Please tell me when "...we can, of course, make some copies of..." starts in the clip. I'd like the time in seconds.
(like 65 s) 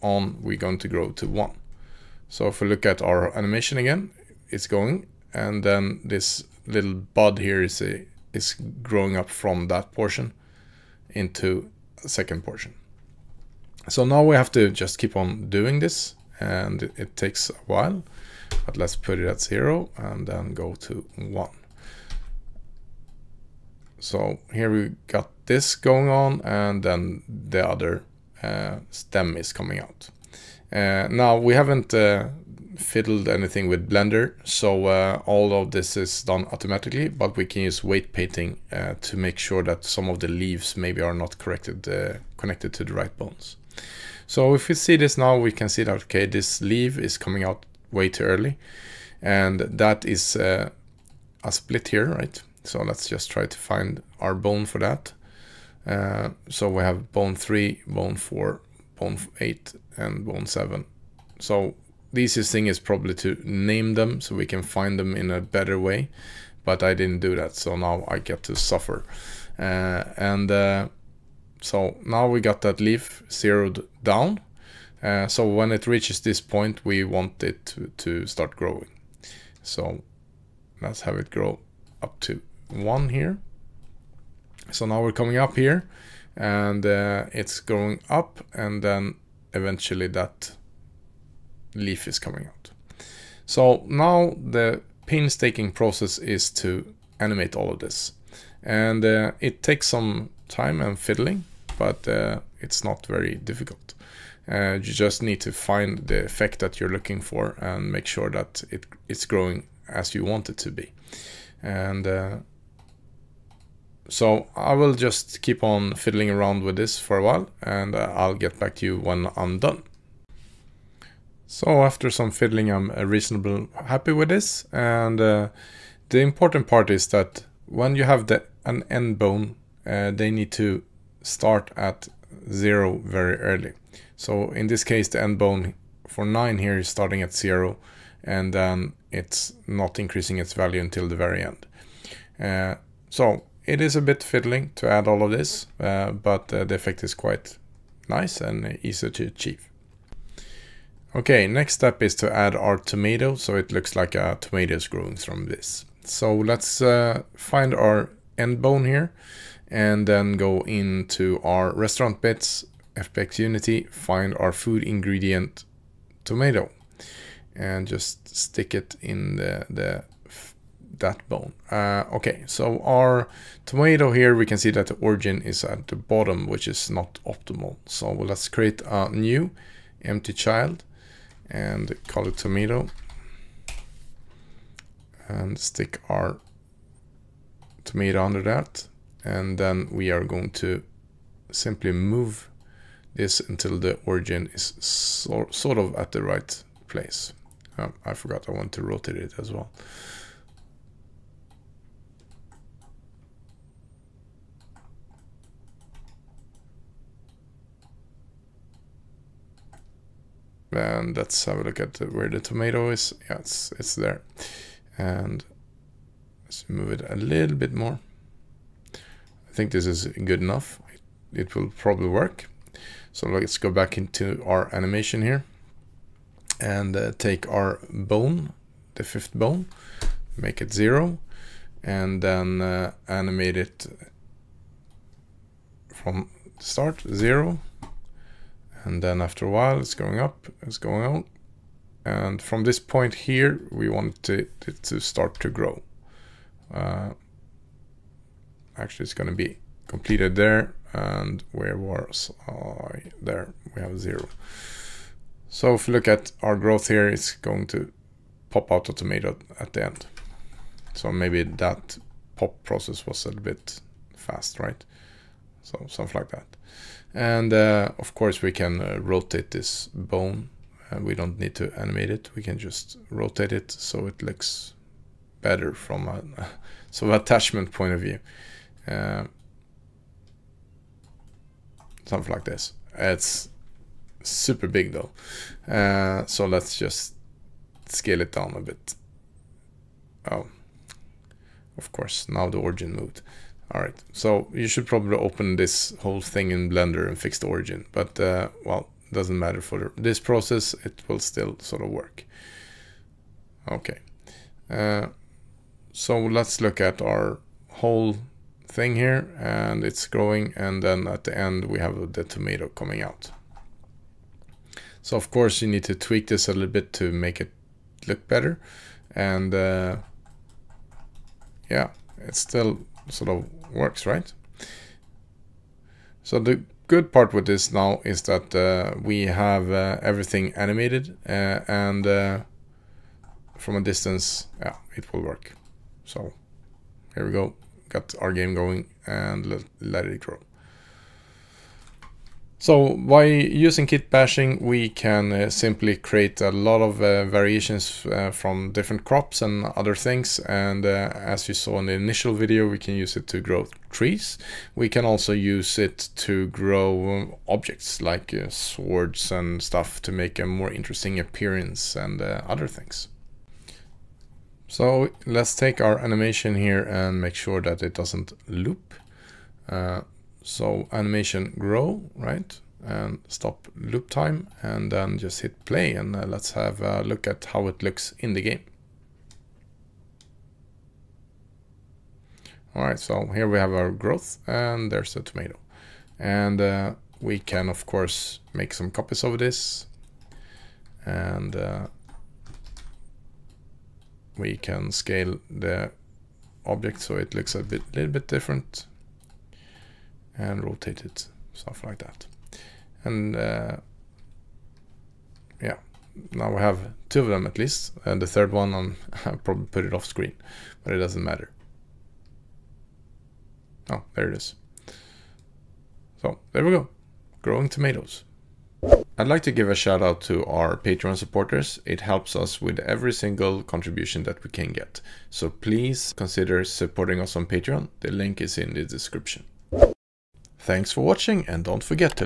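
387 s.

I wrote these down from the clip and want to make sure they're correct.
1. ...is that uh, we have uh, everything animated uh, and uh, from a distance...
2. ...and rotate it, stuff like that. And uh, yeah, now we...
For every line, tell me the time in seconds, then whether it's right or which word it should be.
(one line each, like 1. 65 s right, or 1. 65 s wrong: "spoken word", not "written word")
1. 328 s right
2. 400 s right.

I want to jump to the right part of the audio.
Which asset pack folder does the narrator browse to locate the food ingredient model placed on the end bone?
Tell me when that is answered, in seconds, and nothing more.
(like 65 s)
161 s.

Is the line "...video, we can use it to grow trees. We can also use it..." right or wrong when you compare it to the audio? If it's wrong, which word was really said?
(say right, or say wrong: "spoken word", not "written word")
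right.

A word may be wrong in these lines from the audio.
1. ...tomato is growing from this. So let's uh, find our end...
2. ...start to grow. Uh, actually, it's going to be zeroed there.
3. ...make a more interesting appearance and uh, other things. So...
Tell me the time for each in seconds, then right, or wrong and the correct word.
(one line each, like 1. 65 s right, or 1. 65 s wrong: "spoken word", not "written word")
1. 154 s right
2. 245 s wrong: "completed", not "zeroed"
3. 360 s right.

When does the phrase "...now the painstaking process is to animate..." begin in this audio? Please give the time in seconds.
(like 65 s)
93 s.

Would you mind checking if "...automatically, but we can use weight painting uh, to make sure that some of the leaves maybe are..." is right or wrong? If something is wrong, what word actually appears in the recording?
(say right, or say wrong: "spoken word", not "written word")
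right.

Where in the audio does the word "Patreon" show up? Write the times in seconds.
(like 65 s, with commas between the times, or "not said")
420 s, 427 s.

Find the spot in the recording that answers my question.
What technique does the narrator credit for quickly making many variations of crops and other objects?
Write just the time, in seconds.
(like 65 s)
343 s.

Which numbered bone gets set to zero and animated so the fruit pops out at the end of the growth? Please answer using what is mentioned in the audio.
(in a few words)
fifth bone.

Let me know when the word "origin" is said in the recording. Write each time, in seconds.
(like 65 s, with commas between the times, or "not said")
175 s, 194 s, 292 s, 297 s.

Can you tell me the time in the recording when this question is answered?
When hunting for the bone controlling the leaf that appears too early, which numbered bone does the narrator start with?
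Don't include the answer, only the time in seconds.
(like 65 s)
57 s.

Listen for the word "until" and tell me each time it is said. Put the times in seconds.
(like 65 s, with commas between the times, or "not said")
140 s, 193 s.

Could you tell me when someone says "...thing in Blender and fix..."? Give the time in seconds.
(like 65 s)
296 s.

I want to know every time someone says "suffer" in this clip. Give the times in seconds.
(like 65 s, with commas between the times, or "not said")
68 s.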